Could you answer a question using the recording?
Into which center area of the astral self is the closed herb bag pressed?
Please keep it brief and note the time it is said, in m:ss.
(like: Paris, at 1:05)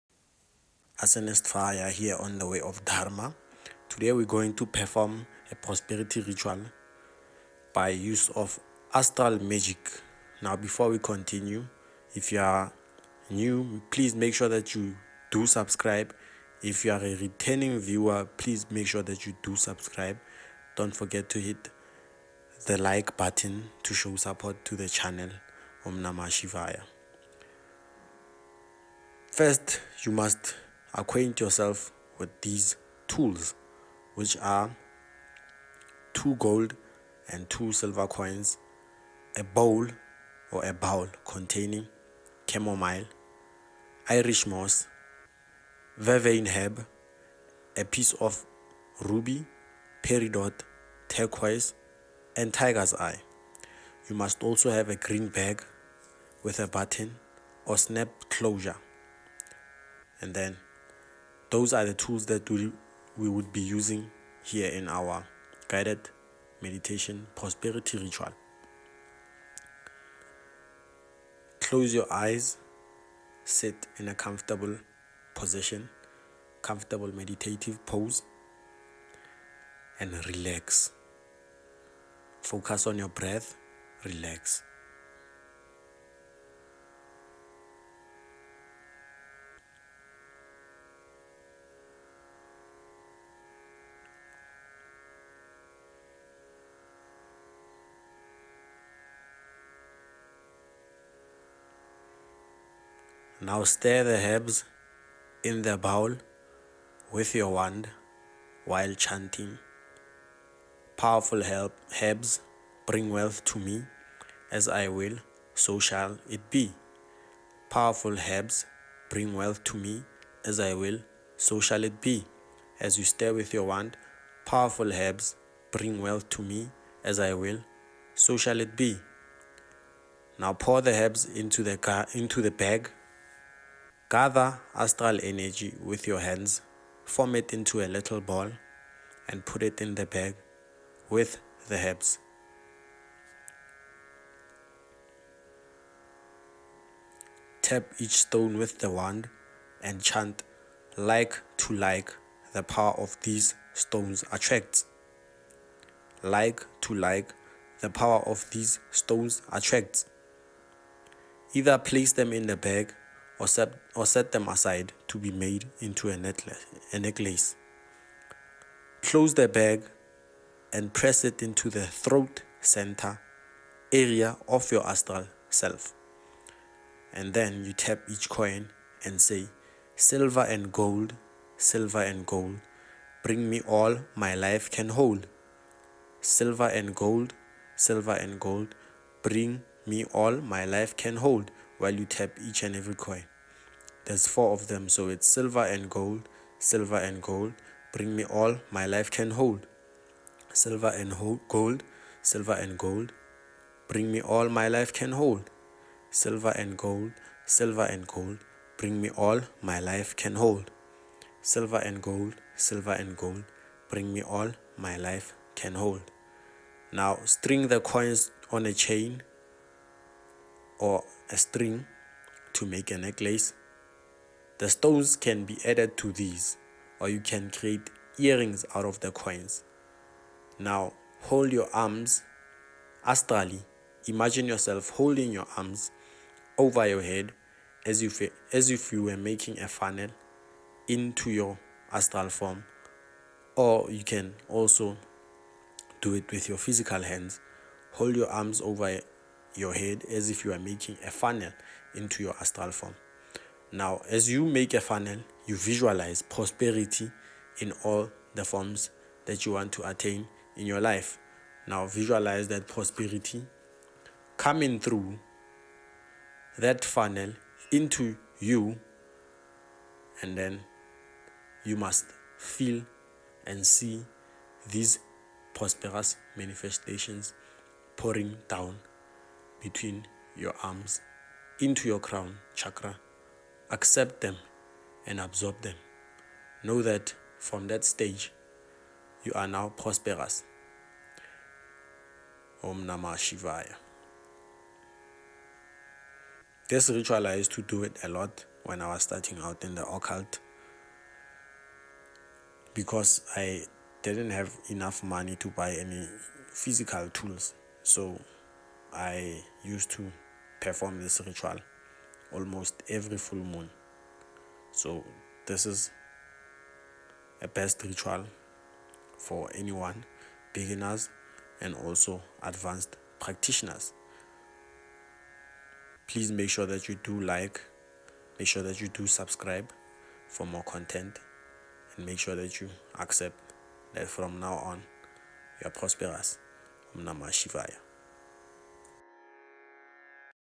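Throat center, at 2:51.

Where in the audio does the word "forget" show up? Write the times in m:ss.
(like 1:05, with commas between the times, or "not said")
0:20.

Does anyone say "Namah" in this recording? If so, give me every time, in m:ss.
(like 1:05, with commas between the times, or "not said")
0:26, 4:52, 5:37.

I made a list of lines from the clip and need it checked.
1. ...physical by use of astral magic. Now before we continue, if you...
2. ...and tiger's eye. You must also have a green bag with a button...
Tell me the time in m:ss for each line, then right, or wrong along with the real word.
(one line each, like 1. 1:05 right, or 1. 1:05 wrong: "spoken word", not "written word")
1. 0:06 wrong: "ritual", not "physical"
2. 0:52 right.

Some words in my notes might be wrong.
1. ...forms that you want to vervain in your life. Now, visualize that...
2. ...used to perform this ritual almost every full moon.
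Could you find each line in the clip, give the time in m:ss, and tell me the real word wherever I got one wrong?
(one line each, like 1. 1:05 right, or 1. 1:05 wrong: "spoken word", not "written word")
1. 4:18 wrong: "attain", not "vervain"
2. 5:09 right.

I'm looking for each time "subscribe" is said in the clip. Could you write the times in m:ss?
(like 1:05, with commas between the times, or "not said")
0:15, 0:19, 5:29.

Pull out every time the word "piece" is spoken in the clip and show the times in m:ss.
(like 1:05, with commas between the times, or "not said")
0:47.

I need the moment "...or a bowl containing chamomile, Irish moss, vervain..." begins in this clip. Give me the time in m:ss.
0:40.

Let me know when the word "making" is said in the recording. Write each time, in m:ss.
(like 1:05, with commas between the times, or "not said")
3:59, 4:10.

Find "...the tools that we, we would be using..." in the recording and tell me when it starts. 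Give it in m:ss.
1:01.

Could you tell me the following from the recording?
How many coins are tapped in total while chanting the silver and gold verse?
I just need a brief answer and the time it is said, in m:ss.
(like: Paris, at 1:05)
4, at 3:14.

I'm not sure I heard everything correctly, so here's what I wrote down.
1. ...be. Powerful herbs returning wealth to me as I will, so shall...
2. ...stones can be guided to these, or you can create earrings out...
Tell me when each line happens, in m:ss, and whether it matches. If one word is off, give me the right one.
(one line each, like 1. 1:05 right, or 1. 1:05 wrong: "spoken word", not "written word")
1. 1:56 wrong: "bring", not "returning"
2. 3:44 wrong: "added", not "guided".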